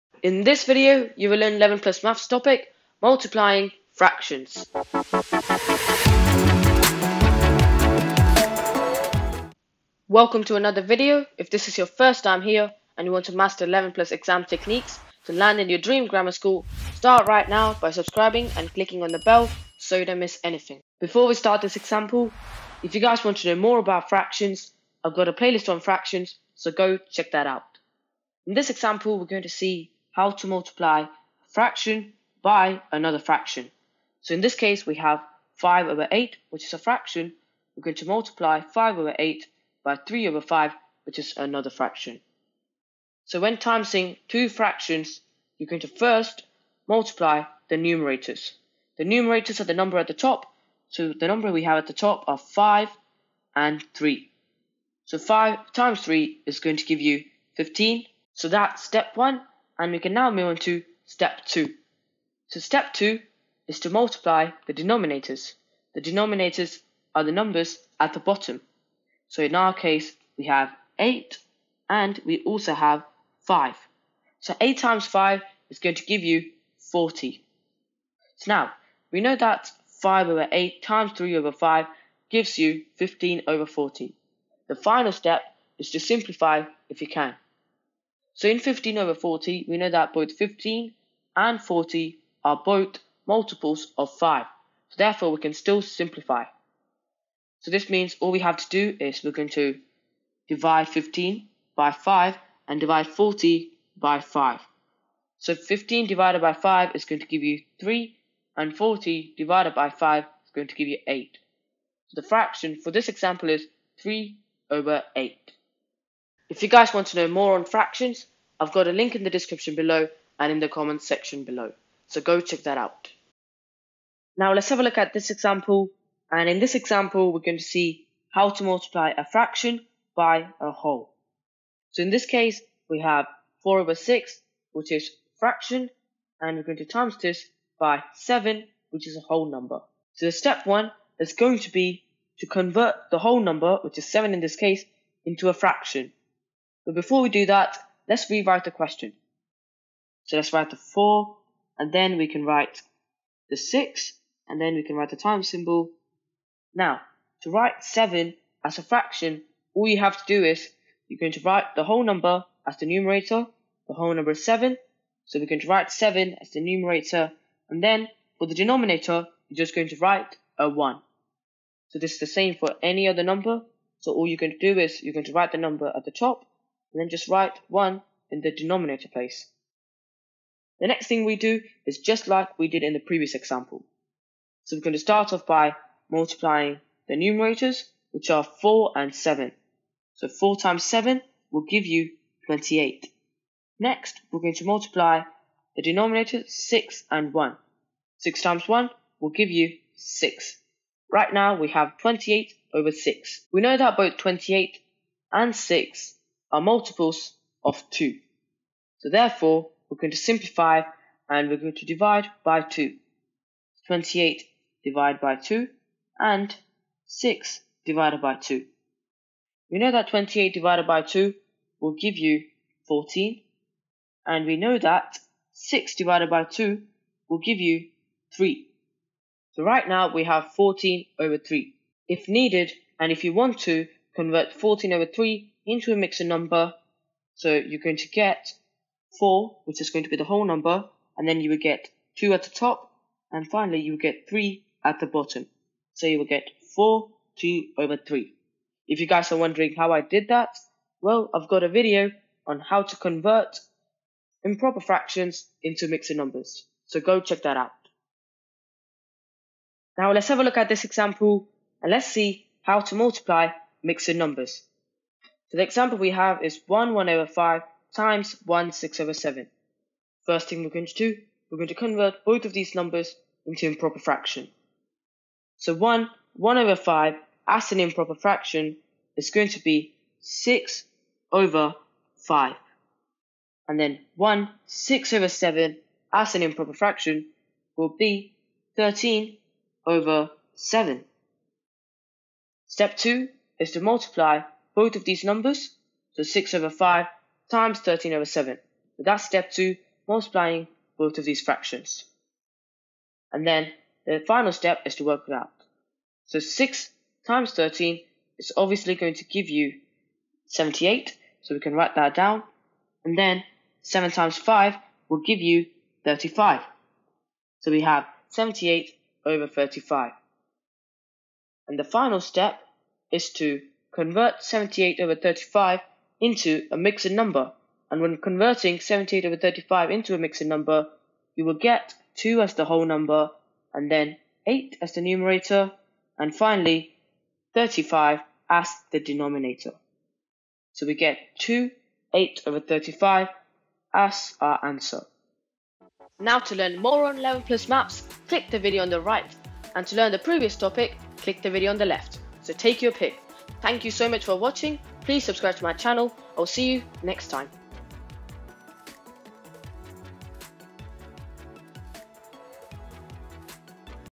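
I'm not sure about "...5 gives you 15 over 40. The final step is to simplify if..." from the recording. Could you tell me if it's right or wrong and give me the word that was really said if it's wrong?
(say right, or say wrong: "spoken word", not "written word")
right.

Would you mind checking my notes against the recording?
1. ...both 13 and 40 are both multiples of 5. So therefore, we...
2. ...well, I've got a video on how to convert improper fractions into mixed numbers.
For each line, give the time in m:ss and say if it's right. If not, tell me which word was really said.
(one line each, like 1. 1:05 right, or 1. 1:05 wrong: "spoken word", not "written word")
1. 1:30 wrong: "15", not "13"
2. 4:11 right.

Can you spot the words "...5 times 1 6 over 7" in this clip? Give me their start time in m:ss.
4:27.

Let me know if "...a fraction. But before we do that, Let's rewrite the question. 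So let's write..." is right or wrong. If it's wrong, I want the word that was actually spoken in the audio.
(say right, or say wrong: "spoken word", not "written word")
right.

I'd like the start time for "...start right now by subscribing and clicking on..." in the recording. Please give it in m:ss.
0:16.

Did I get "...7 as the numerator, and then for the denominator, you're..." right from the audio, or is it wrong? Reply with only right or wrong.
right.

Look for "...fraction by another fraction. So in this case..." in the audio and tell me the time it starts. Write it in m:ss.
0:31.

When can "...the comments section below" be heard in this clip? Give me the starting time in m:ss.
2:00.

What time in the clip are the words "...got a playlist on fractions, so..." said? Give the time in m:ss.
0:25.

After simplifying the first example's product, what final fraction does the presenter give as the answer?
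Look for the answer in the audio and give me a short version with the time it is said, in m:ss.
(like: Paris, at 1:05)
3/8, at 1:54.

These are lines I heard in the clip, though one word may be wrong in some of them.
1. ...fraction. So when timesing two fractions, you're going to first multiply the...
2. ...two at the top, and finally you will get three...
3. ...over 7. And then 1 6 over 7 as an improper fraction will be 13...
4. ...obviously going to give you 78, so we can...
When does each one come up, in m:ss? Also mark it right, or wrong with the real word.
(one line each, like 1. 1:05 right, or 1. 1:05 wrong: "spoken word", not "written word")
1. 0:41 right
2. 4:02 right
3. 4:41 wrong: "5", not "7"
4. 5:08 right.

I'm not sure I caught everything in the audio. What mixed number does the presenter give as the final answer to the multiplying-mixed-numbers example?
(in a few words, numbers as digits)
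2 8/35.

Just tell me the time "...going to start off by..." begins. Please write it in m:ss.
3:04.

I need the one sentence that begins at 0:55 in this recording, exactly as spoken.
So 5 times 3 is going to give you 15.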